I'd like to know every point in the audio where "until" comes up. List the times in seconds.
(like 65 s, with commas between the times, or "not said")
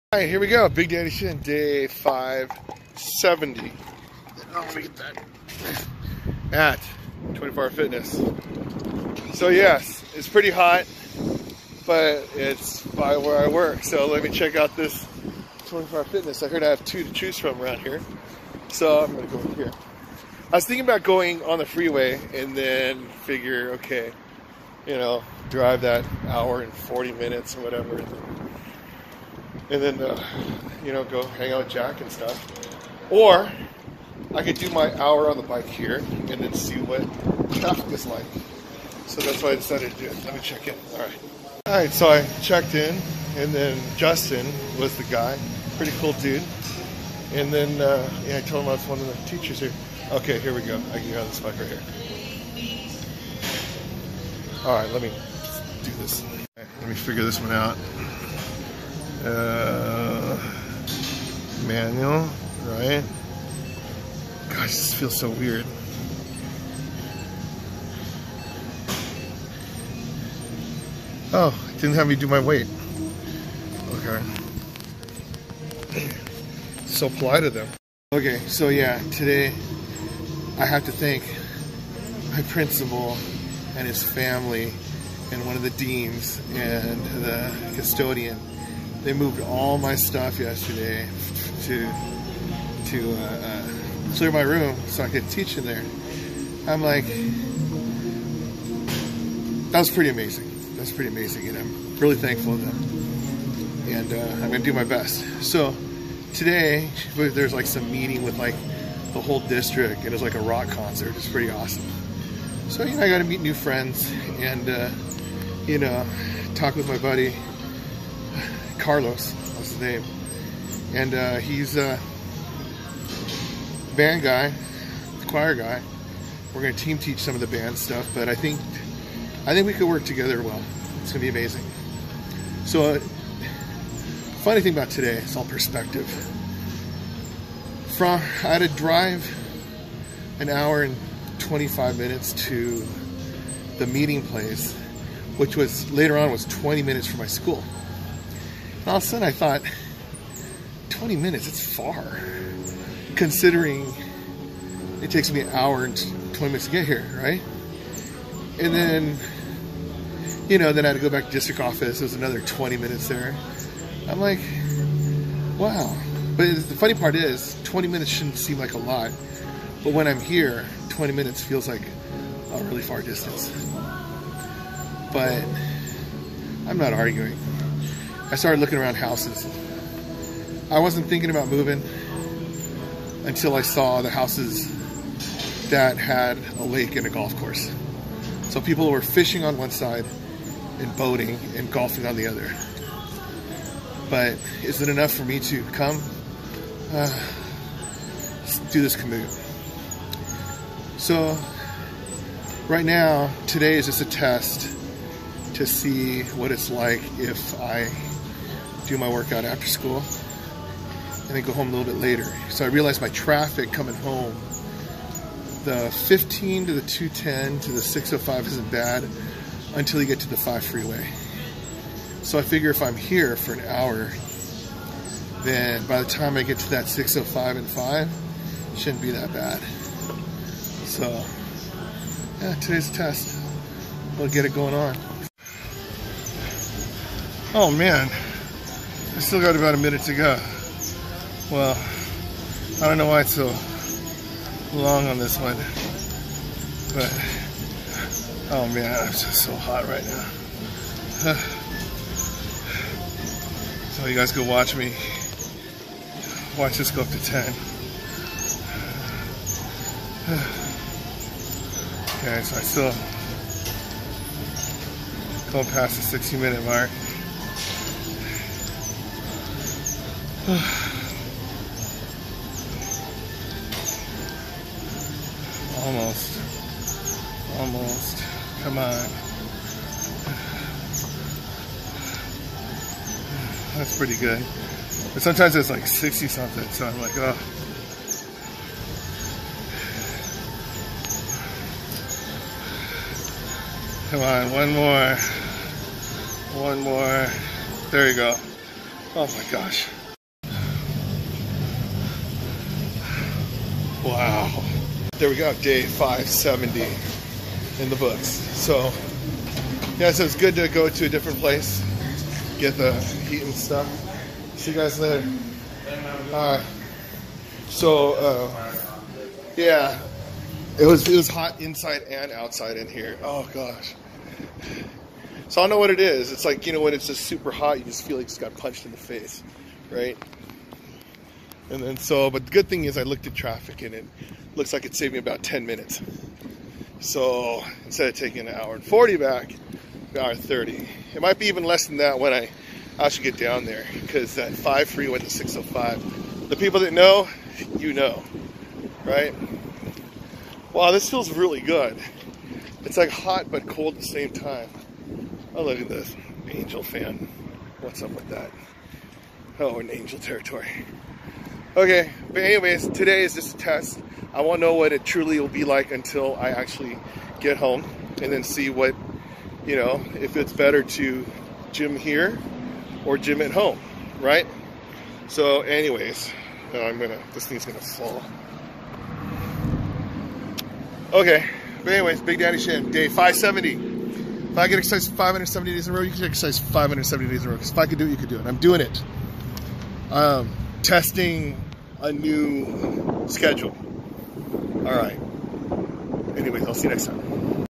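183 s, 219 s, 365 s.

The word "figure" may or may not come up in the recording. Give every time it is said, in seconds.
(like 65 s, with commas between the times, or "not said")
23 s, 56 s, 222 s.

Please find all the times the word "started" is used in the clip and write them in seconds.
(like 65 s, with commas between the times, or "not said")
178 s.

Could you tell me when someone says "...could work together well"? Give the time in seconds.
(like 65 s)
129 s.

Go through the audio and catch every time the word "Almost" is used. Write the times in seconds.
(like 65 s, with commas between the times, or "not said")
270 s, 277 s.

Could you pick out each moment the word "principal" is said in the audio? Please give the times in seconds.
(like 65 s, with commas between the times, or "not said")
82 s.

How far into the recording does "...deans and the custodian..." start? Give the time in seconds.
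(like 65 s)
85 s.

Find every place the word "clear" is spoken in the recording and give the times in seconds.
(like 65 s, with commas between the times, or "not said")
94 s.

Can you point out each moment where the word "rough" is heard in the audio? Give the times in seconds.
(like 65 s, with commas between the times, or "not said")
not said.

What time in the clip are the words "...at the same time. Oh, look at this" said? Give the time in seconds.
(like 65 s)
353 s.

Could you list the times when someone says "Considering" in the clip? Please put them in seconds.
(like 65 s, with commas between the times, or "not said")
153 s.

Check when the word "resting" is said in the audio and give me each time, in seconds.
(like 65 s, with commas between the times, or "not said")
not said.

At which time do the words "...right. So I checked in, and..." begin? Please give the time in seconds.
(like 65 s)
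41 s.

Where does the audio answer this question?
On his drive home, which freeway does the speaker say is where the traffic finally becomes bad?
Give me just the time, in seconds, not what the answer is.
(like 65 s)
220 s.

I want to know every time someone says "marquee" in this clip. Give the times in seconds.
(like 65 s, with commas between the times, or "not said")
not said.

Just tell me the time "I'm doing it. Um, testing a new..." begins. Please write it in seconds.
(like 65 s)
388 s.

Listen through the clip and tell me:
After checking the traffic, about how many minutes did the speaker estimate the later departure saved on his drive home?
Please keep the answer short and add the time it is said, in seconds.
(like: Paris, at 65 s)
10 minutes, at 335 s.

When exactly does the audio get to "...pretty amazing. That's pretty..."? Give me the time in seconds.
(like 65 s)
99 s.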